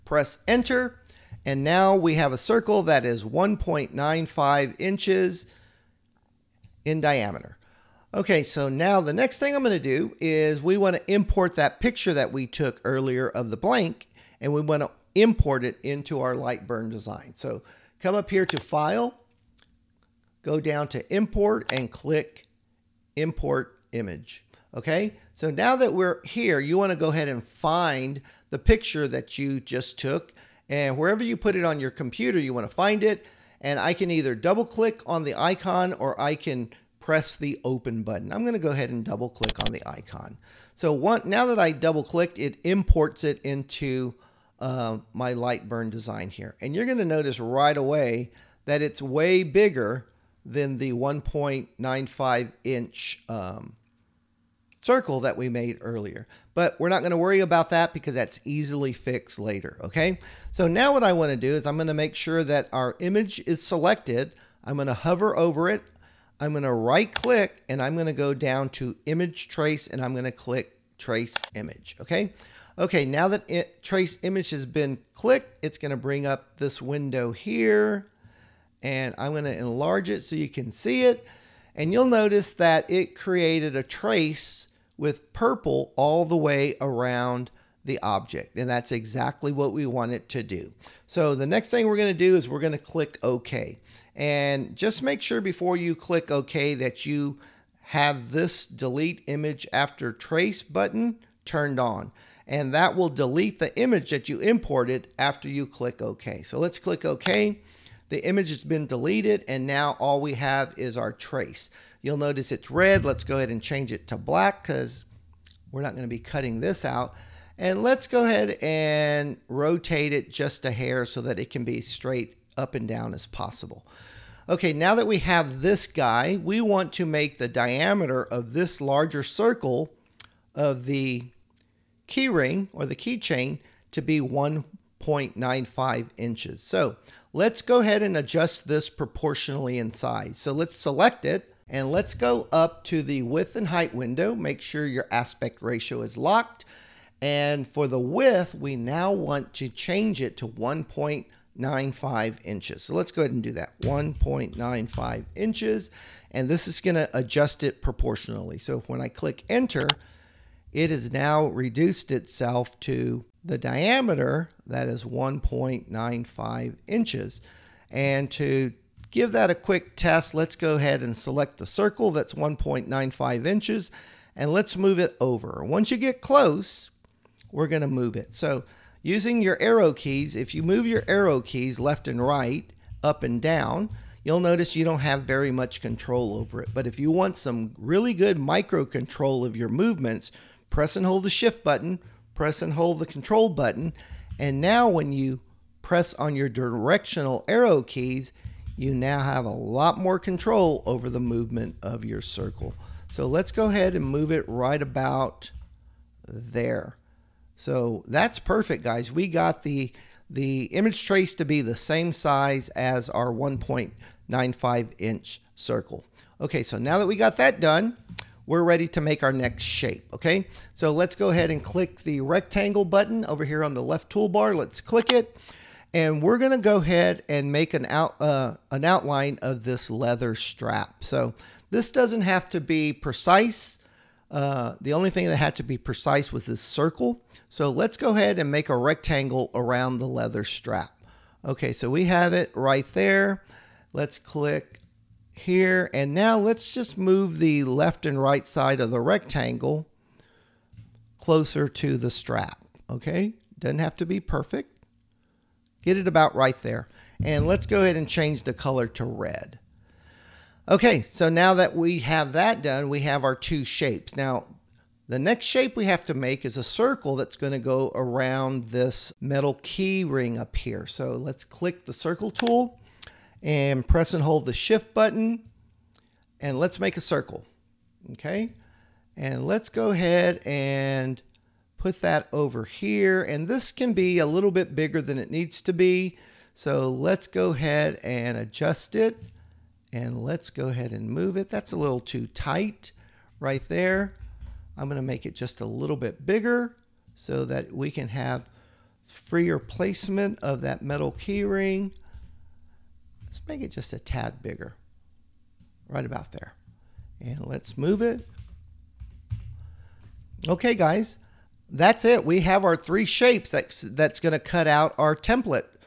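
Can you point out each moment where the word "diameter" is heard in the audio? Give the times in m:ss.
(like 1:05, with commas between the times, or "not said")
0:07, 2:07, 2:43.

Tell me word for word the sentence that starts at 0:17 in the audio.
So come up here to File, go down to Import, and click Import Image.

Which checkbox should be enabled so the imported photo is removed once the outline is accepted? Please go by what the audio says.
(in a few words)
Delete image after trace.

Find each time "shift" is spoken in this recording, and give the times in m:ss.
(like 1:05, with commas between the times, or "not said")
3:11, 4:34.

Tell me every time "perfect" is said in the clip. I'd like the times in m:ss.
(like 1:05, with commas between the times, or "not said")
3:28, 4:14.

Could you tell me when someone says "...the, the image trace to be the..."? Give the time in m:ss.
3:29.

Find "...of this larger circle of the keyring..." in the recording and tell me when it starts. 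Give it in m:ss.
2:08.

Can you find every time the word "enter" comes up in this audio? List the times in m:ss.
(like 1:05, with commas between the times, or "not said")
0:00, 2:39.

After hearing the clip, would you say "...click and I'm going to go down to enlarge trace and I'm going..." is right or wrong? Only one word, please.
wrong.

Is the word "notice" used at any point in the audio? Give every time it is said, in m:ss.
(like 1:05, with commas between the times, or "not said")
0:47, 1:22, 1:52, 3:04.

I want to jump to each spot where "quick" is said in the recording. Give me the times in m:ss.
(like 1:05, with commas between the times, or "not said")
2:49.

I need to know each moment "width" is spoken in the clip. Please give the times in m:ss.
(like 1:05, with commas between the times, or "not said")
2:23, 2:27.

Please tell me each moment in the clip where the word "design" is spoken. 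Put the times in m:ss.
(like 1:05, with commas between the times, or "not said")
0:16, 0:45.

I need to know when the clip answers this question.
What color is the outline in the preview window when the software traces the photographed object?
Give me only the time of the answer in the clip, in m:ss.
1:25.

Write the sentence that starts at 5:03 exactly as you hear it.
Let's make it just a tad bigger, right about there.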